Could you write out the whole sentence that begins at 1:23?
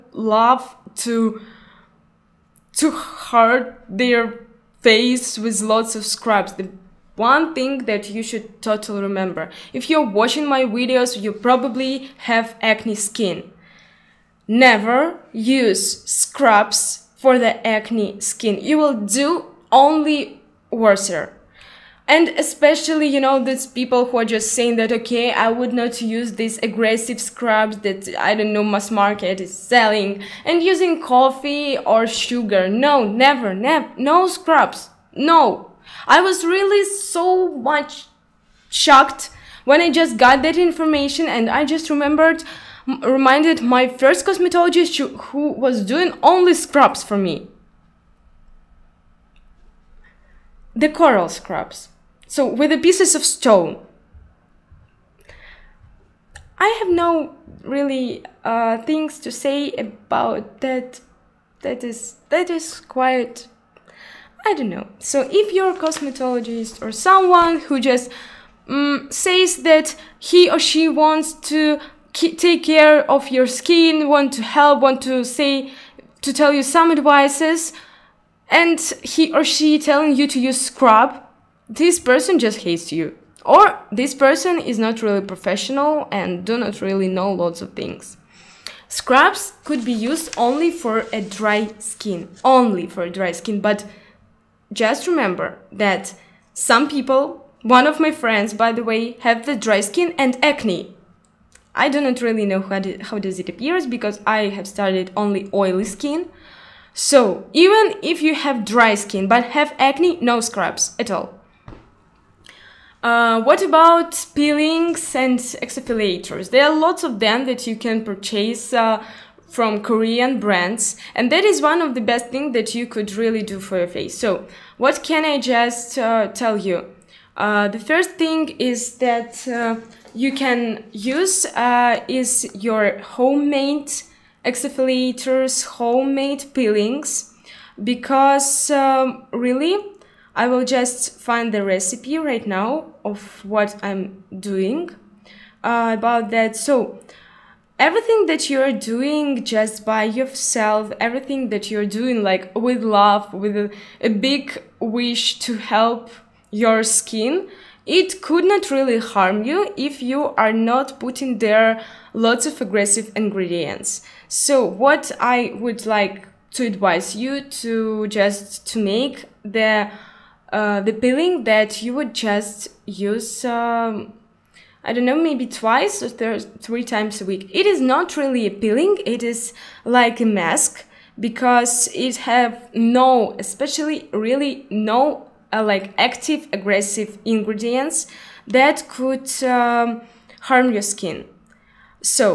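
Or this person is not really professional and do not really know lots of things.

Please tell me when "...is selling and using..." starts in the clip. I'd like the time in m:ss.
0:29.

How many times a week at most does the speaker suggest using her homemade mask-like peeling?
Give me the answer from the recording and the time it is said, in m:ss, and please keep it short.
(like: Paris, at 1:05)
3, at 2:56.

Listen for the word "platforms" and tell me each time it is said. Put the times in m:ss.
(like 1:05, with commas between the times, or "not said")
not said.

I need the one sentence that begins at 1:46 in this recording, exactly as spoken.
So even if you have dry skin but have acne, no scrubs at all.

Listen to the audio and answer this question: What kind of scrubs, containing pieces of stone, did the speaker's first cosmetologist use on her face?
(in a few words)
Coral scrubs.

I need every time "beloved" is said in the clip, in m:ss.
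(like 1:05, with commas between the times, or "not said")
not said.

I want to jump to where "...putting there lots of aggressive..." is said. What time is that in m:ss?
2:40.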